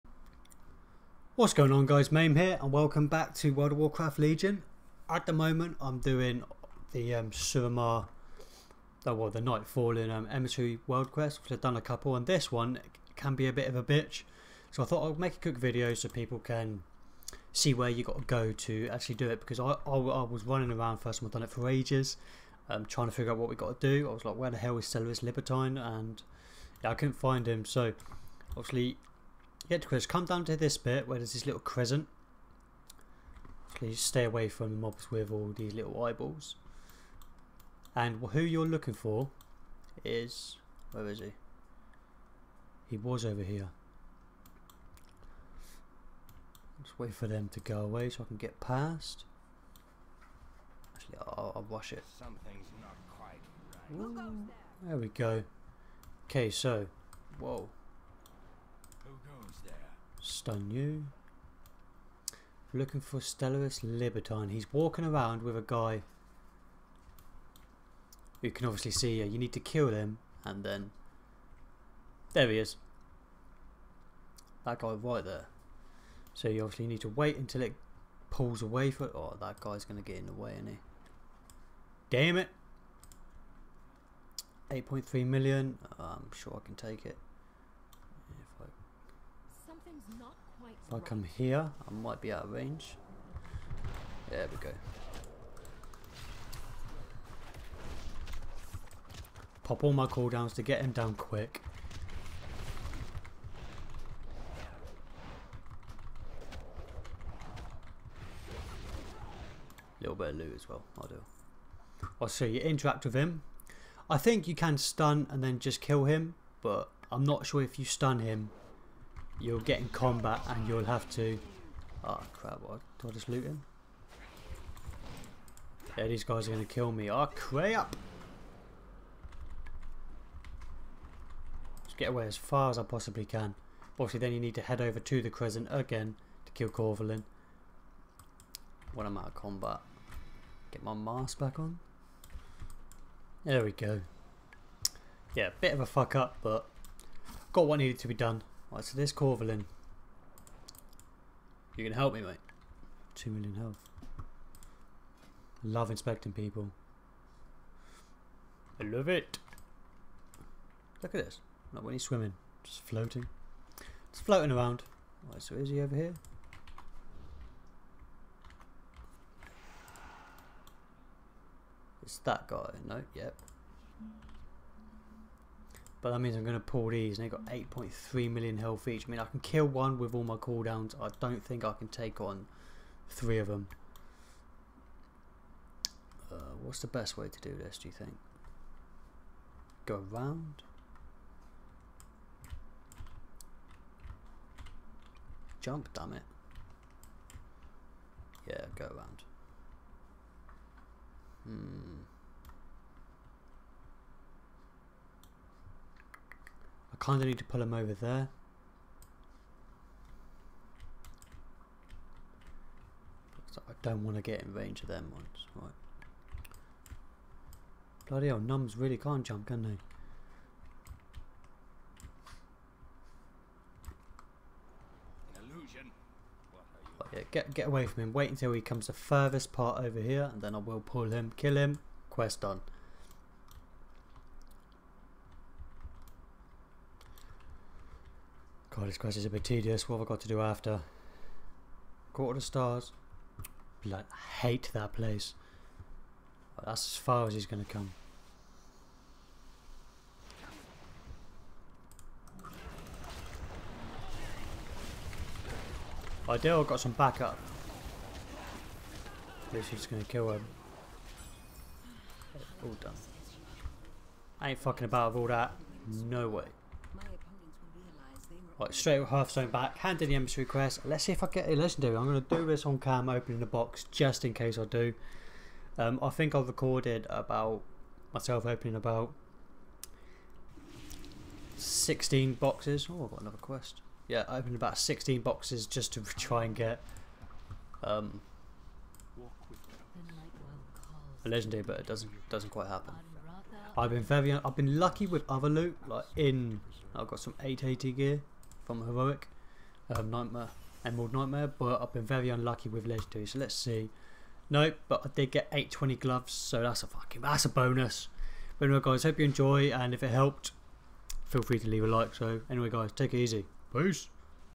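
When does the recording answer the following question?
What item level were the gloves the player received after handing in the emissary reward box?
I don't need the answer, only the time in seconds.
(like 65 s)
305 s.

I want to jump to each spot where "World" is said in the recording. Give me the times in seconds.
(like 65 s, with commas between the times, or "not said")
3 s, 10 s.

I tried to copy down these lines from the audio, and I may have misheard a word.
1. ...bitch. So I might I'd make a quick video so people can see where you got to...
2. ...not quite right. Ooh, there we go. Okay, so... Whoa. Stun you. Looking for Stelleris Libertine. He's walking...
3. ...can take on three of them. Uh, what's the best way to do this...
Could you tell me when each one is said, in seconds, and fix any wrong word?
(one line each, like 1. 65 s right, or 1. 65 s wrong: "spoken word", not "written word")
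1. 13 s wrong: "thought", not "might"
2. 52 s right
3. 181 s right.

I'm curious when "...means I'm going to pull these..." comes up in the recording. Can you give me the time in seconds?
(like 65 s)
176 s.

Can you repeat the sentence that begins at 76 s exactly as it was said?
So you obviously need to wait until it pulls away for...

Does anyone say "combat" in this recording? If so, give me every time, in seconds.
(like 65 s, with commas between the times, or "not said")
119 s, 139 s.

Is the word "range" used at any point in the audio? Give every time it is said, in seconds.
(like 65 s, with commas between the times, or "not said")
92 s, 214 s.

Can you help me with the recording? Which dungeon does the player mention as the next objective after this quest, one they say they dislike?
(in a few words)
Court of Stars.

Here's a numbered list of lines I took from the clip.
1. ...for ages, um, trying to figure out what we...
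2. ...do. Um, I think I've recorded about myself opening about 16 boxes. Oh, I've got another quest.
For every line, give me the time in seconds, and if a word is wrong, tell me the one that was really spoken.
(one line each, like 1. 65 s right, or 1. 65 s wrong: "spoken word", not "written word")
1. 21 s right
2. 274 s right.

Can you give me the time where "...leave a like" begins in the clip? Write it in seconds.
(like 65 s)
311 s.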